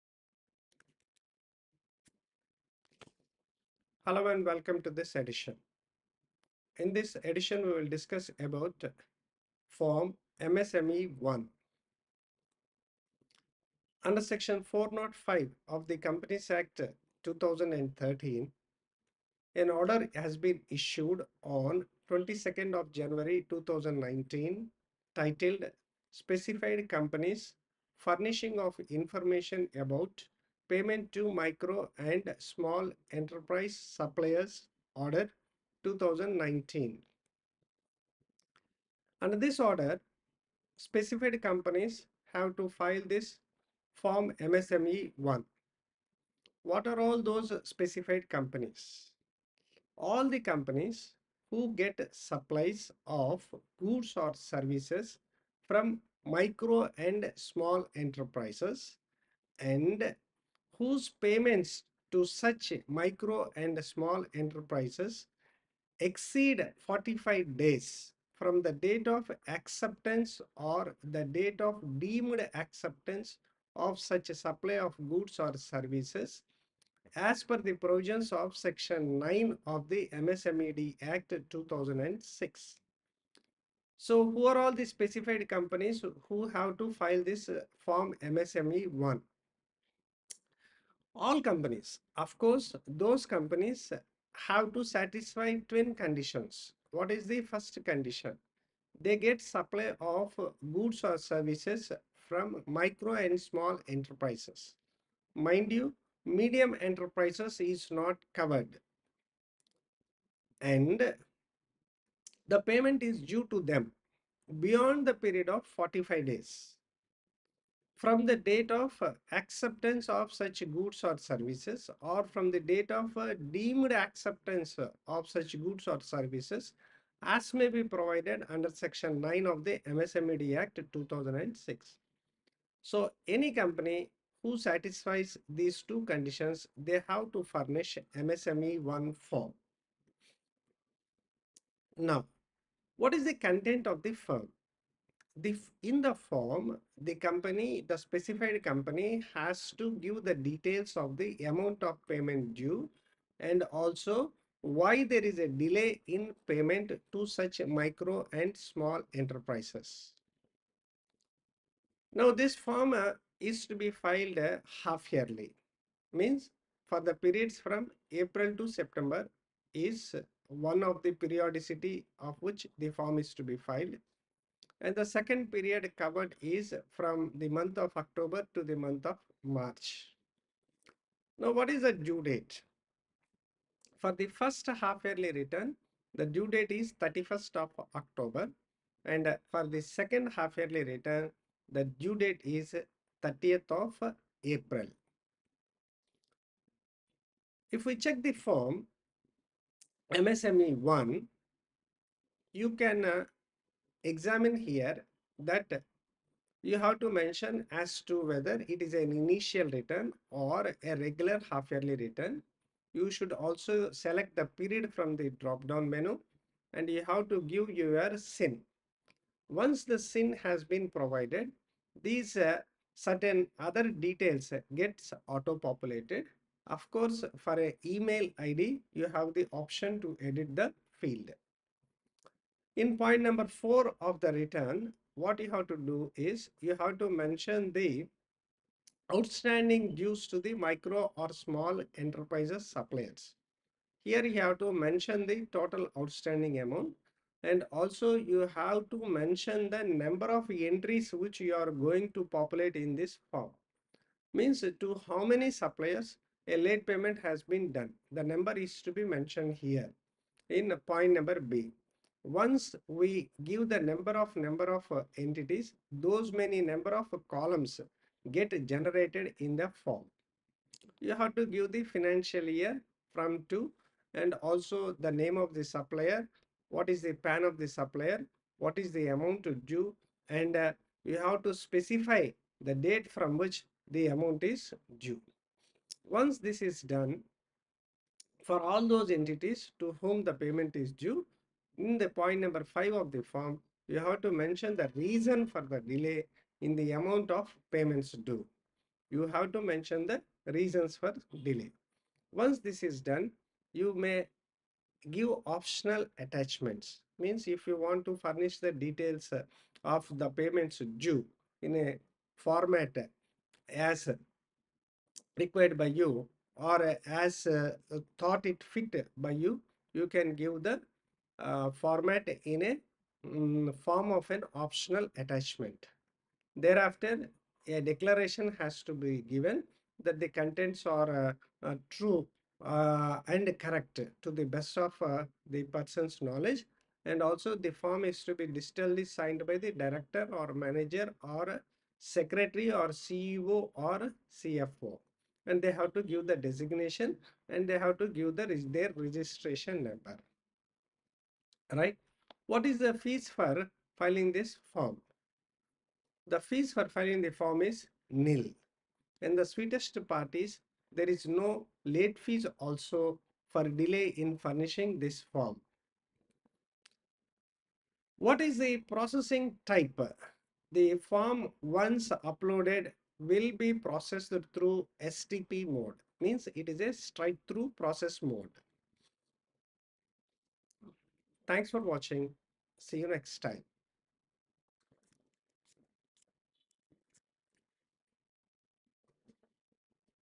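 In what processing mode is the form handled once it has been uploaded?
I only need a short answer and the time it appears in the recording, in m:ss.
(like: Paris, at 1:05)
STP mode, at 6:15.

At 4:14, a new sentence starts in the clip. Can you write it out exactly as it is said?
Means to how many suppliers a late payment has been done.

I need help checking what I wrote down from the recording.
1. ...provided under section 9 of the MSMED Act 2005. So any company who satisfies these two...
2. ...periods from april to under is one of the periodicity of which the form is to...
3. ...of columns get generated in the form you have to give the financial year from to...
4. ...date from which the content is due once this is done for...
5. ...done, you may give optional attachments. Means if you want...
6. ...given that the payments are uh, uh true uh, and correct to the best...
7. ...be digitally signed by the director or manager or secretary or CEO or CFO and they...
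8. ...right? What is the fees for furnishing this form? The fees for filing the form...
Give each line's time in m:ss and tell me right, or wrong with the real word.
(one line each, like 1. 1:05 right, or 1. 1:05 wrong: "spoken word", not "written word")
1. 2:07 wrong: "2006", not "2005"
2. 2:47 wrong: "september", not "under"
3. 4:26 right
4. 4:42 wrong: "amount", not "content"
5. 5:03 right
6. 5:29 wrong: "contents", not "payments"
7. 5:38 right
8. 5:51 wrong: "filing", not "furnishing".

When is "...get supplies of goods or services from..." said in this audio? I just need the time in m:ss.
0:51.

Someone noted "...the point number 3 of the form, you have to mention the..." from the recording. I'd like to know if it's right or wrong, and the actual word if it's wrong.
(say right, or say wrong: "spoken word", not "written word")
wrong: "5", not "3".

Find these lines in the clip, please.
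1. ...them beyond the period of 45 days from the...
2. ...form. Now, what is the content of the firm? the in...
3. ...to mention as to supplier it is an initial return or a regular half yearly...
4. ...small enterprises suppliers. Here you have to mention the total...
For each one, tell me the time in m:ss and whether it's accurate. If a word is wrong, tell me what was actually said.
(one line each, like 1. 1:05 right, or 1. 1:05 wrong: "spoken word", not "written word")
1. 1:53 right
2. 2:19 right
3. 3:26 wrong: "whether", not "supplier"
4. 4:01 right.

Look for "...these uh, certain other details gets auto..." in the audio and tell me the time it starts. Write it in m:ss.
3:42.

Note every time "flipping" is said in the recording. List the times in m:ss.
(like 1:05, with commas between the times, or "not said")
not said.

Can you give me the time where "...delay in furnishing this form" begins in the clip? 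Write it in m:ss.
6:03.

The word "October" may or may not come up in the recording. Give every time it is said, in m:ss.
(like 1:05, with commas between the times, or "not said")
2:57, 3:07.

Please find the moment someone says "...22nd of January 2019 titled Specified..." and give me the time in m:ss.
0:22.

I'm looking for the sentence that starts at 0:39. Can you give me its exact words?
Under this order, specified companies have to file this form MSME 1.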